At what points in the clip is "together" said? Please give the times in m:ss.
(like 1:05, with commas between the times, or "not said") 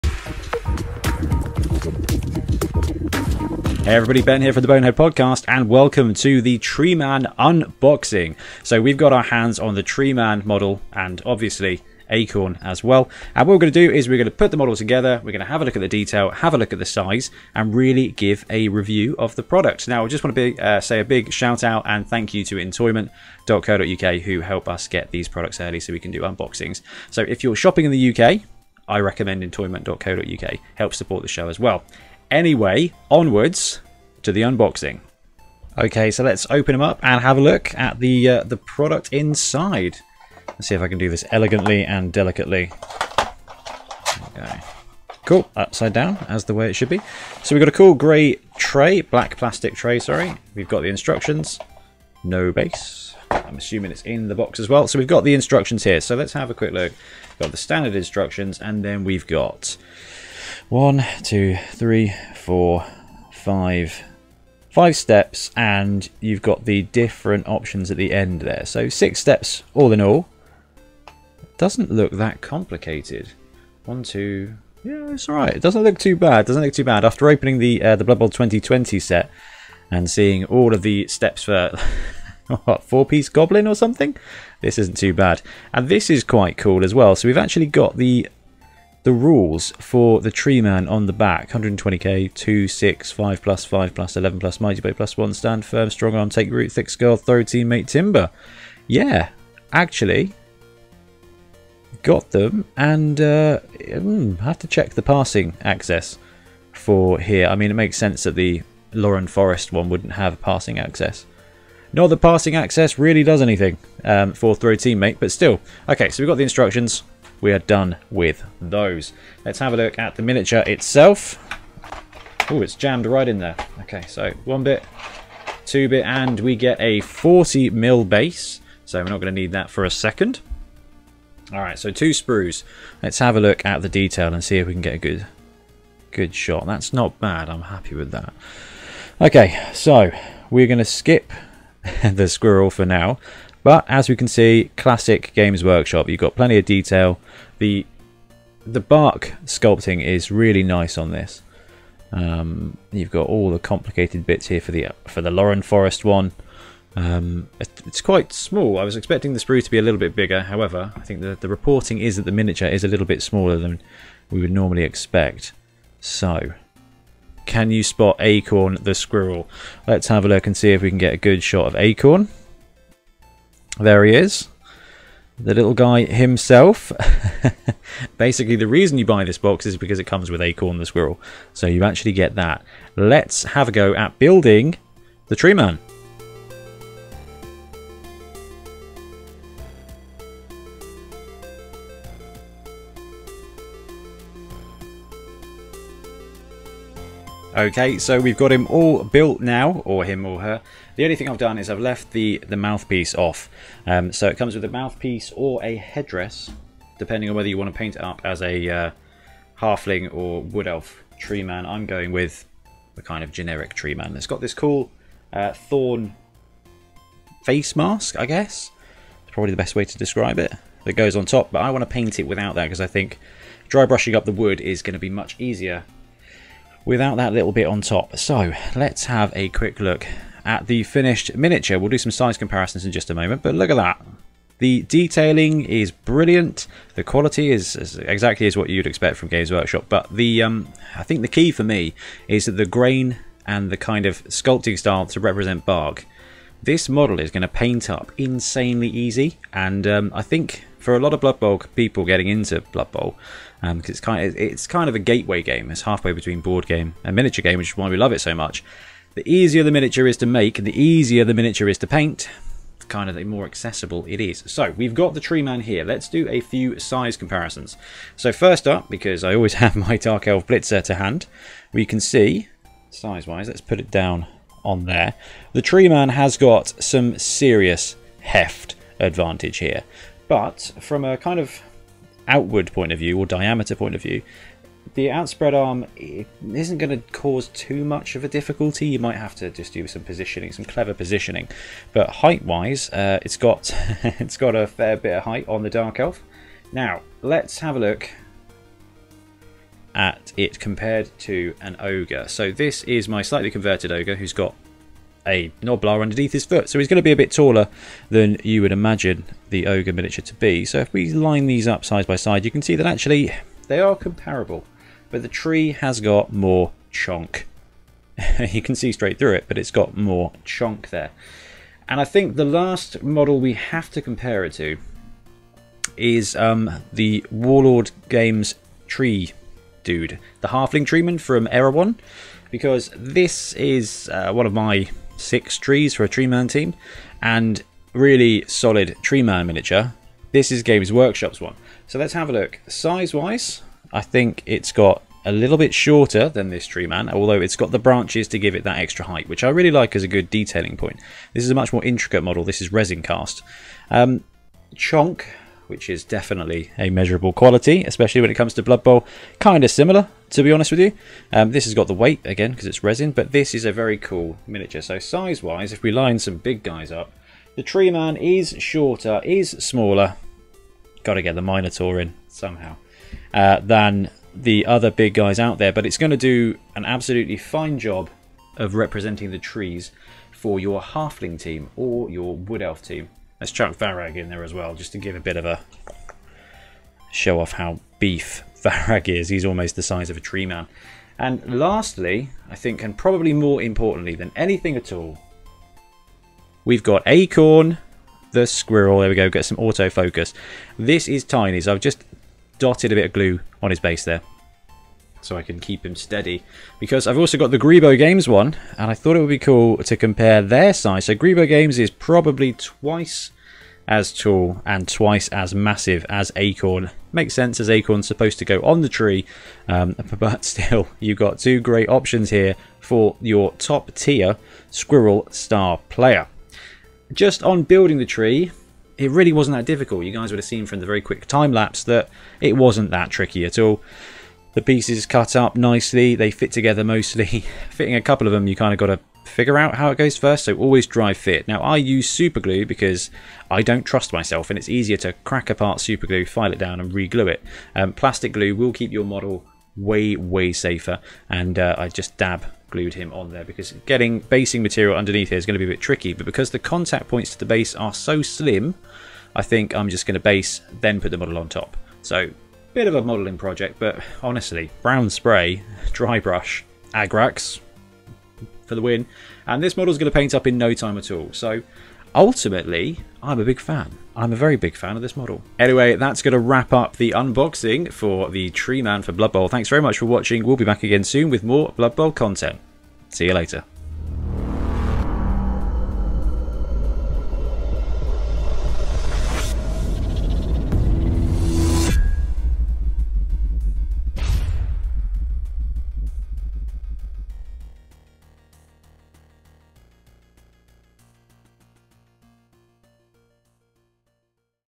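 0:14, 7:16.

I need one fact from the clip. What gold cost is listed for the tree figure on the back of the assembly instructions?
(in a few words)
120k.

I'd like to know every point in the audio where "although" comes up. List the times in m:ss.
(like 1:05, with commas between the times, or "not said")
5:47.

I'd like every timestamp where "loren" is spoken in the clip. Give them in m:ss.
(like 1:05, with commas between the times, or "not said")
1:48, 2:35.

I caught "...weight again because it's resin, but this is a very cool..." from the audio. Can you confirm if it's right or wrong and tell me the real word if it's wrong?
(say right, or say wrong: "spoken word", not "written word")
right.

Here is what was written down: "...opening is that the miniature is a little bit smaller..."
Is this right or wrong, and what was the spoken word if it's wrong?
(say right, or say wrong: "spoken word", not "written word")
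wrong: "reporting", not "opening".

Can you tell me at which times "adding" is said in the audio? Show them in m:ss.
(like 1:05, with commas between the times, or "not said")
not said.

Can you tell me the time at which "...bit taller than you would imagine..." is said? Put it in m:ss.
5:07.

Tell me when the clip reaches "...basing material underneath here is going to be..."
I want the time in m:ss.
7:34.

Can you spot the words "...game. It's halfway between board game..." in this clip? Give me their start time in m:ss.
4:15.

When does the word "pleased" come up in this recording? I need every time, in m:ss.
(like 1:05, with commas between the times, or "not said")
not said.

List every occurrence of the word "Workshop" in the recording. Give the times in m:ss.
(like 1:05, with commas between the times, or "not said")
2:25, 3:59, 5:40.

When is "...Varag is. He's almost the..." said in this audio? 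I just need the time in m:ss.
6:28.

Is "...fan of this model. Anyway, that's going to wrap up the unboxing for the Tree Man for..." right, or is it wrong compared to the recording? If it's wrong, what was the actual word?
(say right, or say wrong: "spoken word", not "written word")
right.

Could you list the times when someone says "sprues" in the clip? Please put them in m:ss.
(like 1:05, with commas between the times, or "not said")
2:12, 2:39.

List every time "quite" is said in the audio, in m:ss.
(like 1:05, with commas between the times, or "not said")
1:26, 2:38.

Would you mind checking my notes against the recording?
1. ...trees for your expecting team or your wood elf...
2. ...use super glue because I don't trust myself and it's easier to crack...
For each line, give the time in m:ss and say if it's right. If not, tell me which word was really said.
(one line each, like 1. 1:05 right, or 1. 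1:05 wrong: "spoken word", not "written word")
1. 6:19 wrong: "halfling", not "expecting"
2. 7:21 right.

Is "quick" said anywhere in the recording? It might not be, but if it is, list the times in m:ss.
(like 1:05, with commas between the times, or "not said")
0:56, 3:49, 7:11.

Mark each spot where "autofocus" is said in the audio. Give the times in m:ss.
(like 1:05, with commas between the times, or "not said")
6:39.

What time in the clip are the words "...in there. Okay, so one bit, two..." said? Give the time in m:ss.
2:03.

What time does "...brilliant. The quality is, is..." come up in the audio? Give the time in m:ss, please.
3:55.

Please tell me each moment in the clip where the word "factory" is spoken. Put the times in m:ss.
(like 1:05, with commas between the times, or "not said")
not said.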